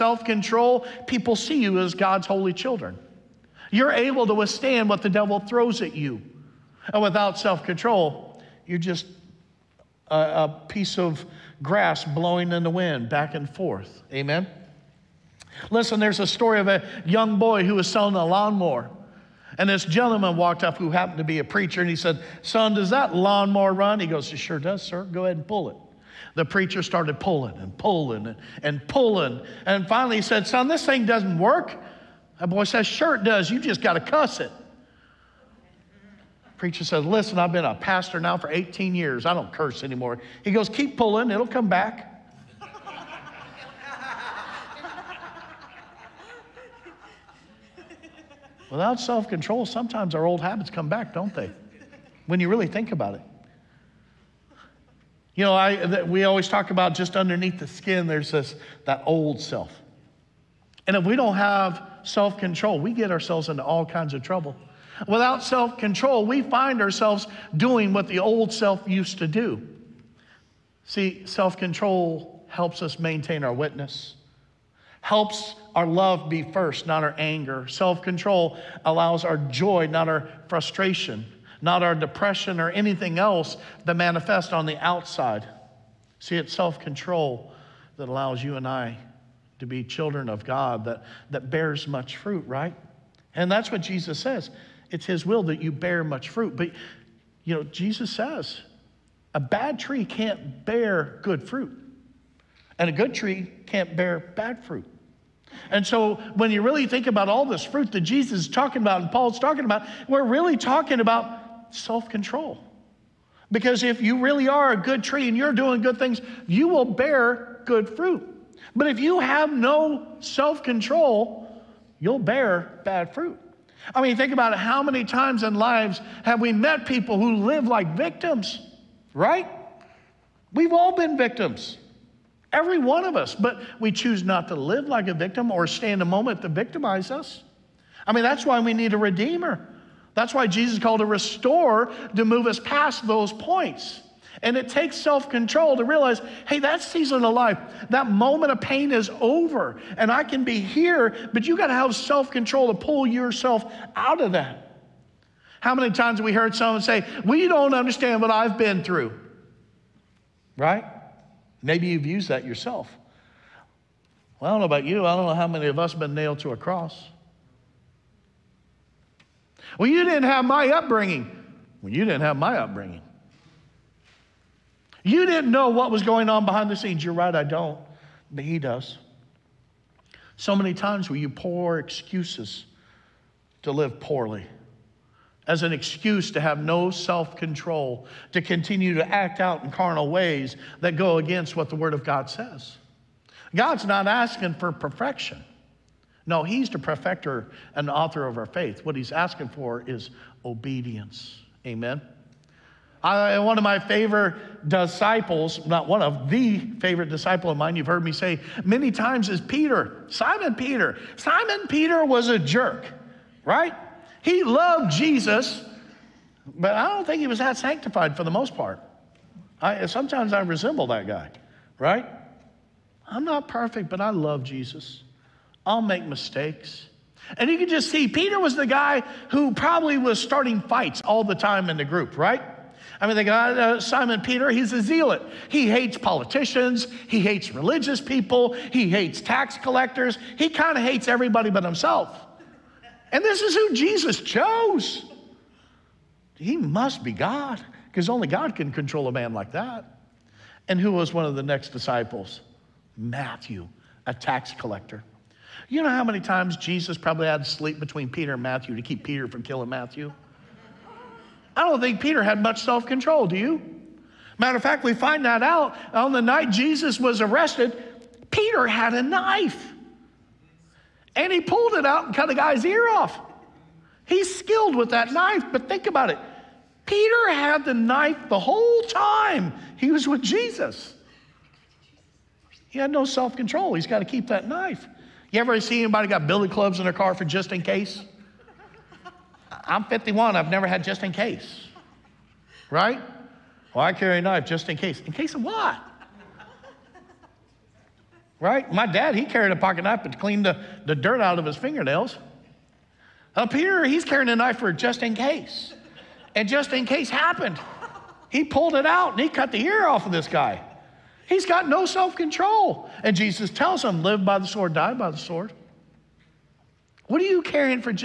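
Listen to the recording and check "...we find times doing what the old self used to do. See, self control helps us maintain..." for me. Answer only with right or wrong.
wrong.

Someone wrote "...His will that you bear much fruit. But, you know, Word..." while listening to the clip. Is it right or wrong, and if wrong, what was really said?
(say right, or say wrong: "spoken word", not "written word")
wrong: "Jesus", not "Word".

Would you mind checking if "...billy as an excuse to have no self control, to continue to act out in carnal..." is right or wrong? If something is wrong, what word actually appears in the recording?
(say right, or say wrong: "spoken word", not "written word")
wrong: "poorly", not "billy".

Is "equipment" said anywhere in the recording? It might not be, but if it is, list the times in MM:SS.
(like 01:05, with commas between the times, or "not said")
not said.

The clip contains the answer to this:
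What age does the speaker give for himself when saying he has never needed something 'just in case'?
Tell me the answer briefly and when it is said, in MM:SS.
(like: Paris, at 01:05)
51, at 04:49.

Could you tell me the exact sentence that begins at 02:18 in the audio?
I mean, that's why we need a redeemer.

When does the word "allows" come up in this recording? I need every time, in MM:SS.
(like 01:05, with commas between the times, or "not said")
01:18, 01:28.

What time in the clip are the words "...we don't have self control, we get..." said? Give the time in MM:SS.
01:01.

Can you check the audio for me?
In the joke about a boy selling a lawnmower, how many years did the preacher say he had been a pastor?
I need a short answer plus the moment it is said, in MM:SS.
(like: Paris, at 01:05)
18, at 00:38.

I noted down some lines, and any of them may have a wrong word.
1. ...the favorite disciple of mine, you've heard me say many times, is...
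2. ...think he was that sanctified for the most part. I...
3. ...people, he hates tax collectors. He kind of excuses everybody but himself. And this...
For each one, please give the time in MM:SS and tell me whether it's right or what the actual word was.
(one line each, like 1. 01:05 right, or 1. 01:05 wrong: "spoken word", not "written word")
1. 03:26 right
2. 03:37 right
3. 03:57 wrong: "hates", not "excuses".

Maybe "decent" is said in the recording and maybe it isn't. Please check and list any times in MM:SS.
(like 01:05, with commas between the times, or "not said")
not said.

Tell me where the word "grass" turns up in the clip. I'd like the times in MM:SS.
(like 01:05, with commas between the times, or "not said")
00:11.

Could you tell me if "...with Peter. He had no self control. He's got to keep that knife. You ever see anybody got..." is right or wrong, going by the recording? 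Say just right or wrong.
wrong.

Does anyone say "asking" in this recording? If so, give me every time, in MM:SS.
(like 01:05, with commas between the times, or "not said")
03:14, 03:19.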